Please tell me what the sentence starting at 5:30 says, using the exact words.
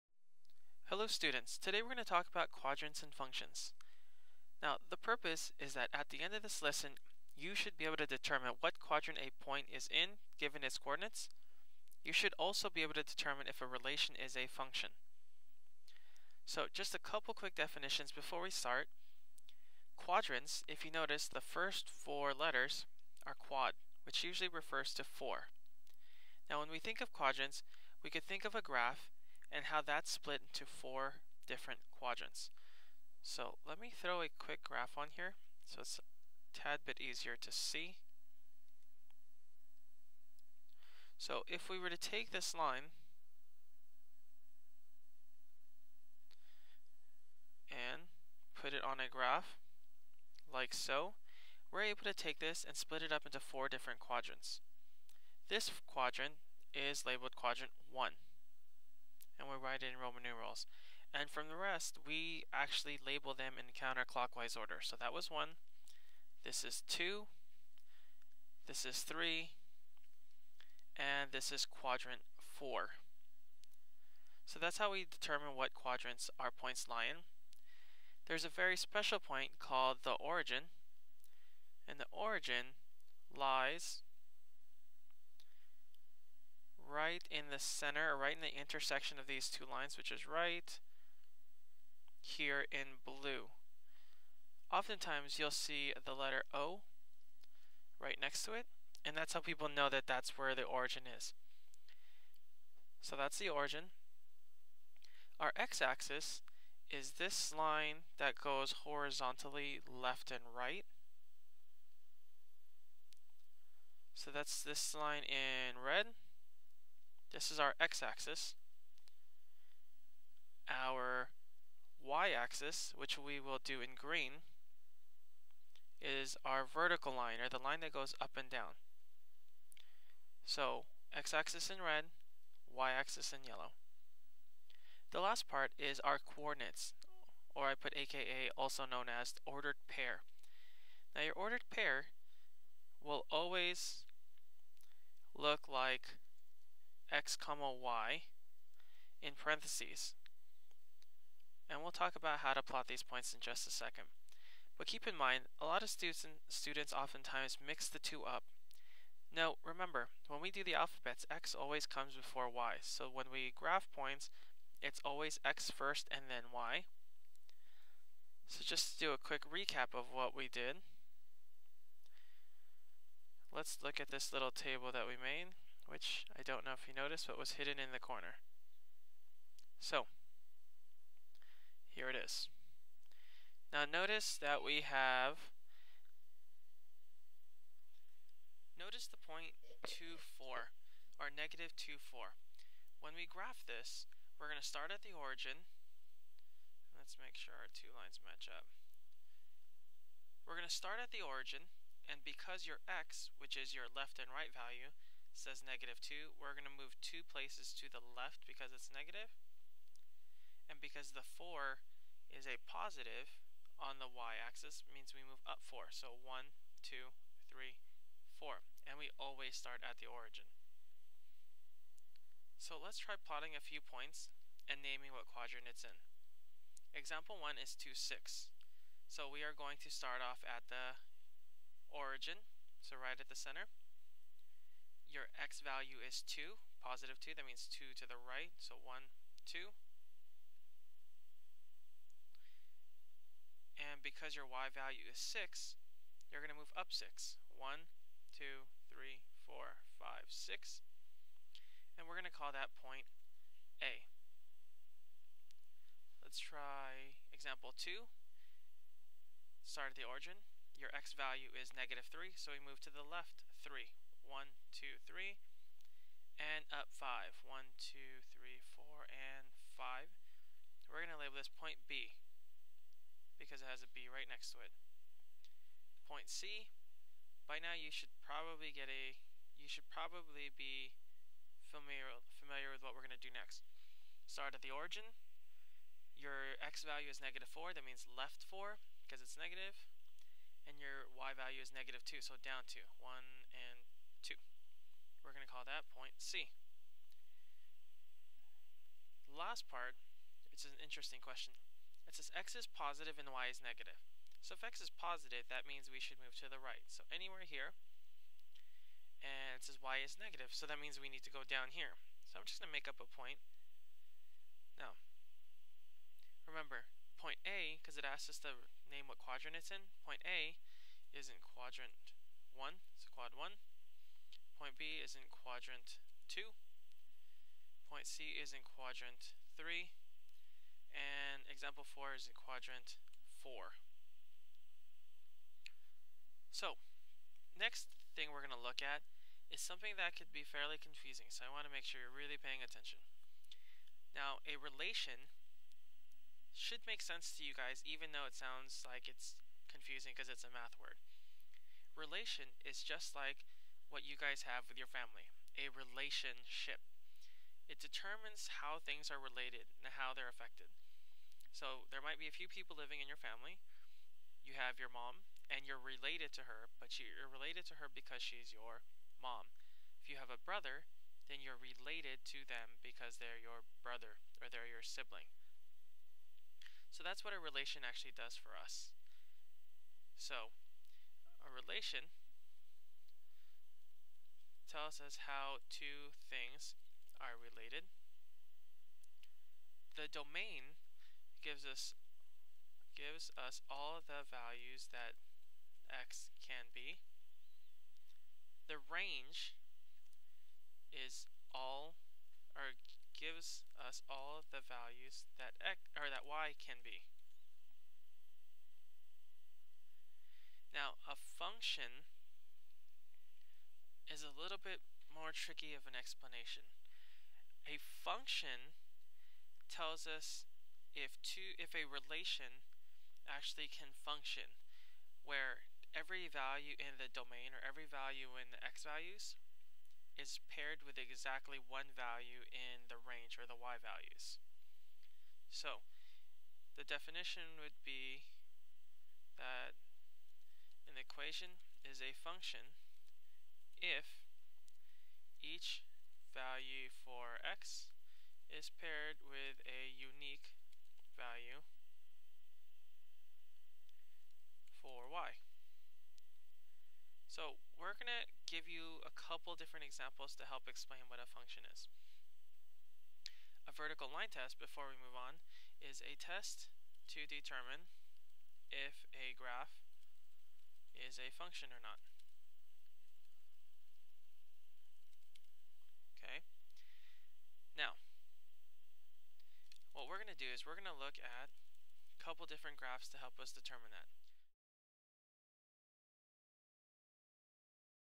And example 4 is in quadrant 4.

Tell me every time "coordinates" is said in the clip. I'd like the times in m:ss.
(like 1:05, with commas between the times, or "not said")
0:10, 2:16.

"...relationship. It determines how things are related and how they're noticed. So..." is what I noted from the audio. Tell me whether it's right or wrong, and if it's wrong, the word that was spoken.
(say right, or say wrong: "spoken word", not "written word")
wrong: "affected", not "noticed".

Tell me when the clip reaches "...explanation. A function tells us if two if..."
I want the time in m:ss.
6:55.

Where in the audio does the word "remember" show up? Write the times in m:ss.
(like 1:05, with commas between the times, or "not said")
2:39, 5:16.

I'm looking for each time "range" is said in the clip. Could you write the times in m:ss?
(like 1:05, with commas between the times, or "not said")
6:38, 7:12.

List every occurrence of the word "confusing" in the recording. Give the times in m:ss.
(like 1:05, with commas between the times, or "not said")
5:40, 5:49.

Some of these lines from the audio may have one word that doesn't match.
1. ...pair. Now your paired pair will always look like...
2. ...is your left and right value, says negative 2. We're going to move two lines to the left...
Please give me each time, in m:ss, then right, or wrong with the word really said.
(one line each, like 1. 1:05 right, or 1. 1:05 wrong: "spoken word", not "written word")
1. 2:19 wrong: "ordered", not "paired"
2. 3:23 wrong: "places", not "lines".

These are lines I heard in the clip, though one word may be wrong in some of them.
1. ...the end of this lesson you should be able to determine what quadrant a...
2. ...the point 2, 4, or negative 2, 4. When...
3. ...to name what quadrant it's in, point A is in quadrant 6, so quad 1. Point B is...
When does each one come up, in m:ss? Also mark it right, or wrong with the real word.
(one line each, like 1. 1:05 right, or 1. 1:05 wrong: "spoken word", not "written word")
1. 0:06 right
2. 3:09 right
3. 5:18 wrong: "1", not "6".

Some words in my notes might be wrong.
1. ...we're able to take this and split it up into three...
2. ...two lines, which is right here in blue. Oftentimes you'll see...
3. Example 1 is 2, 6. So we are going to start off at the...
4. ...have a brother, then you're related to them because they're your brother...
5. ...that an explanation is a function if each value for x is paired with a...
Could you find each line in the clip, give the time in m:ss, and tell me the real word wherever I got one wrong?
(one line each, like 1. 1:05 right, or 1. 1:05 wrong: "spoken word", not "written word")
1. 0:51 wrong: "four", not "three"
2. 1:29 right
3. 3:46 right
4. 6:10 right
5. 7:19 wrong: "equation", not "explanation".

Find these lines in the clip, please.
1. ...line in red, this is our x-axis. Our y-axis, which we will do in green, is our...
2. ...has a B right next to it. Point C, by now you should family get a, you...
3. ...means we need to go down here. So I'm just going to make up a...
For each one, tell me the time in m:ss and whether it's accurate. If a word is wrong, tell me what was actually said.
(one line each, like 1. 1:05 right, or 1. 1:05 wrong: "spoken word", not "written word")
1. 1:54 right
2. 4:33 wrong: "probably", not "family"
3. 5:10 right.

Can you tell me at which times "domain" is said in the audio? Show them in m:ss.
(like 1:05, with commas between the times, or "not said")
6:30, 7:07.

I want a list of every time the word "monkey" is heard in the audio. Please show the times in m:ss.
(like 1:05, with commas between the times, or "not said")
not said.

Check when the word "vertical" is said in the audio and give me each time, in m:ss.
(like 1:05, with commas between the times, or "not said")
2:06, 7:43.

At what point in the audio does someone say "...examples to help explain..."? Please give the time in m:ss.
7:39.